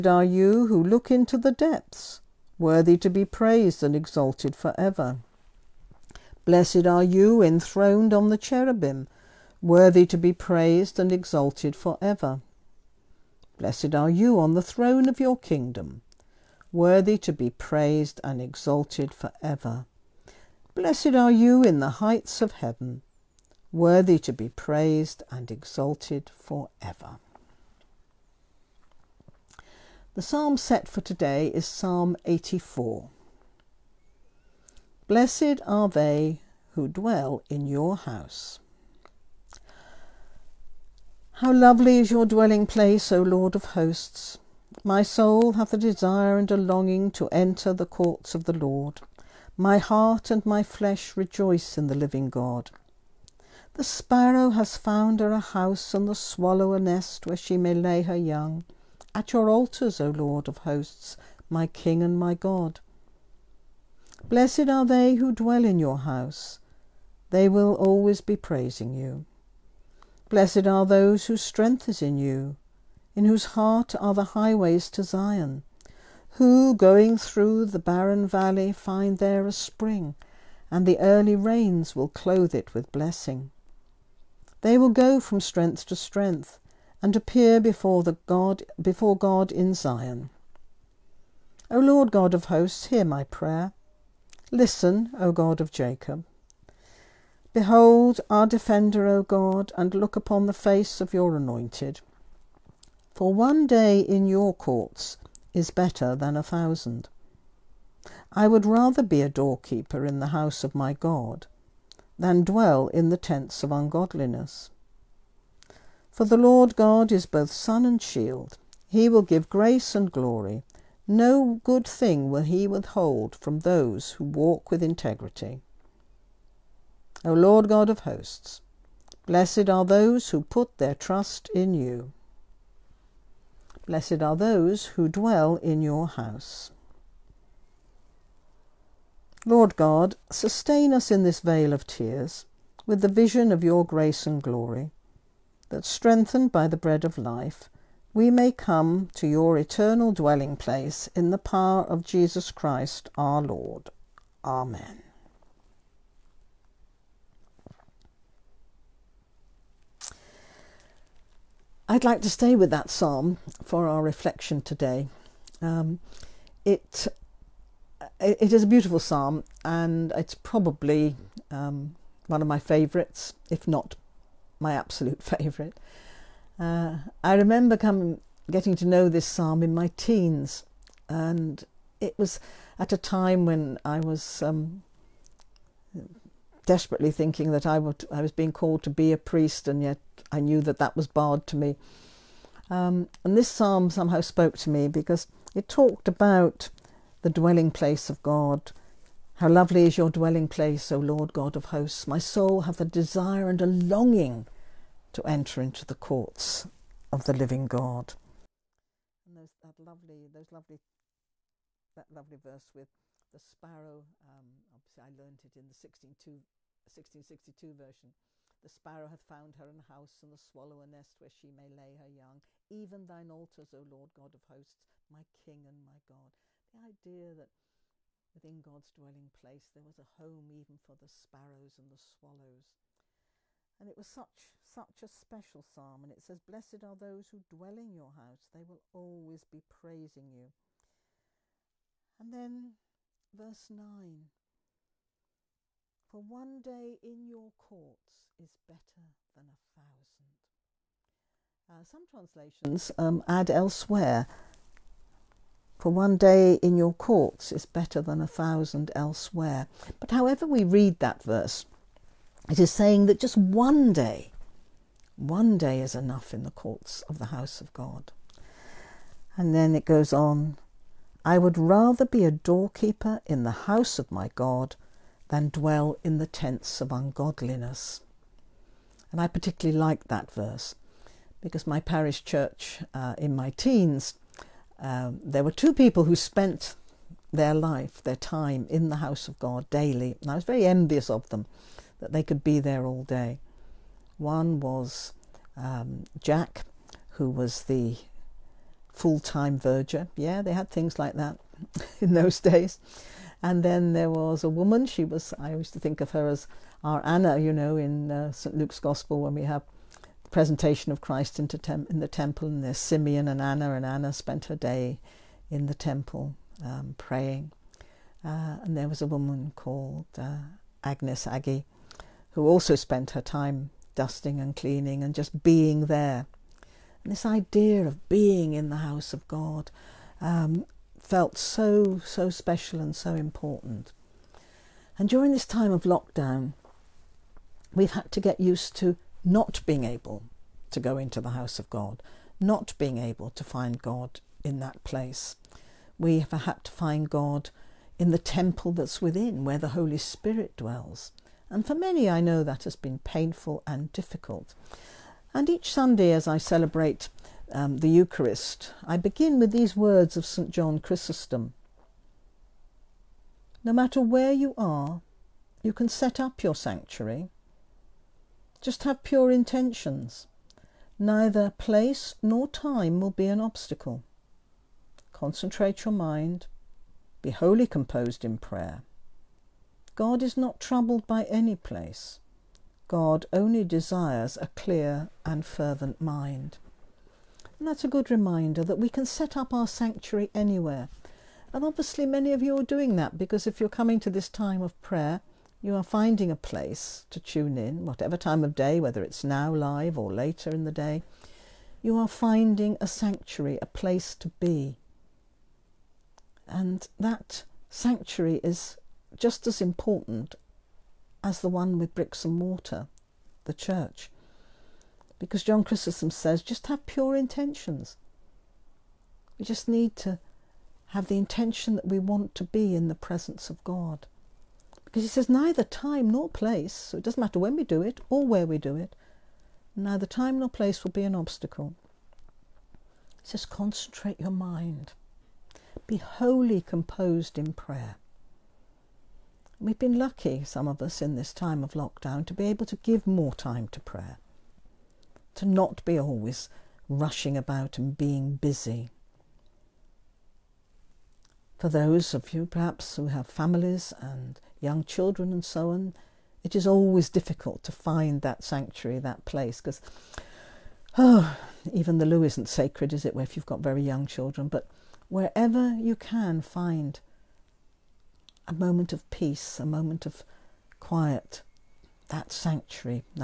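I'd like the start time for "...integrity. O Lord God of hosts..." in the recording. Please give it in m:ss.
2:04.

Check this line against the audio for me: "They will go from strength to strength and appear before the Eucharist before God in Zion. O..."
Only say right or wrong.
wrong.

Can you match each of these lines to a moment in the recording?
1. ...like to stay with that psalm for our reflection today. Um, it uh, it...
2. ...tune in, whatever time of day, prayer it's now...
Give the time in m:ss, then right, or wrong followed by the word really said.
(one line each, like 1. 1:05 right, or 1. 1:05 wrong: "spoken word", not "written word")
1. 2:42 right
2. 6:37 wrong: "whether", not "prayer".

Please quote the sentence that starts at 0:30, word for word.
The psalm set for today is Psalm 84.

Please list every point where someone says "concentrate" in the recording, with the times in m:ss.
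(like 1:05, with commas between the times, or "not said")
6:15, 7:13.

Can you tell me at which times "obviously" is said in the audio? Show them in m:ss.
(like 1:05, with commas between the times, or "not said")
3:34, 6:31.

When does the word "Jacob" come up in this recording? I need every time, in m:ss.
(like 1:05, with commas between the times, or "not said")
1:35.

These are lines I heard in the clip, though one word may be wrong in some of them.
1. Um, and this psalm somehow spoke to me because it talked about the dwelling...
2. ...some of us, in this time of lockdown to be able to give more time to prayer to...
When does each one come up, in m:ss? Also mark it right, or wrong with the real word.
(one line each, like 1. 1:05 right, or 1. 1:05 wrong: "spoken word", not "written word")
1. 3:12 right
2. 7:20 right.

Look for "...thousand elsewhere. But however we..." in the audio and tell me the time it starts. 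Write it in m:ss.
4:18.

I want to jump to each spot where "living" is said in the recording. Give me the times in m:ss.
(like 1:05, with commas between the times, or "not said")
0:51, 3:27.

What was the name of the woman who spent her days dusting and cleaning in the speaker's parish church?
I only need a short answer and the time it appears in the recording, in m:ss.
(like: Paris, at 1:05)
Agnes, at 5:20.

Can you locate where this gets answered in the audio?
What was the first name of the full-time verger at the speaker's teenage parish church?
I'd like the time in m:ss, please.
4:56.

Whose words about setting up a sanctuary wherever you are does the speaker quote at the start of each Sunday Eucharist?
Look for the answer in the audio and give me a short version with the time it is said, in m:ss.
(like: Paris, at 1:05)
St. John Chrysostom, at 6:00.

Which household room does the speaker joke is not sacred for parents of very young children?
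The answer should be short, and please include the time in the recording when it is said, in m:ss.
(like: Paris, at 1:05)
the loo, at 7:41.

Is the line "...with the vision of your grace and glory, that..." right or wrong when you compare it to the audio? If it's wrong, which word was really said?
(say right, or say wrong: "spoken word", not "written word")
right.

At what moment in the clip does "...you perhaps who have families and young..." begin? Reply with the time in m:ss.
7:32.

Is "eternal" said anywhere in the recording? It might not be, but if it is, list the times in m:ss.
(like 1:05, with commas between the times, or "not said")
2:29.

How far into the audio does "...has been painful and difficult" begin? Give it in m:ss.
5:52.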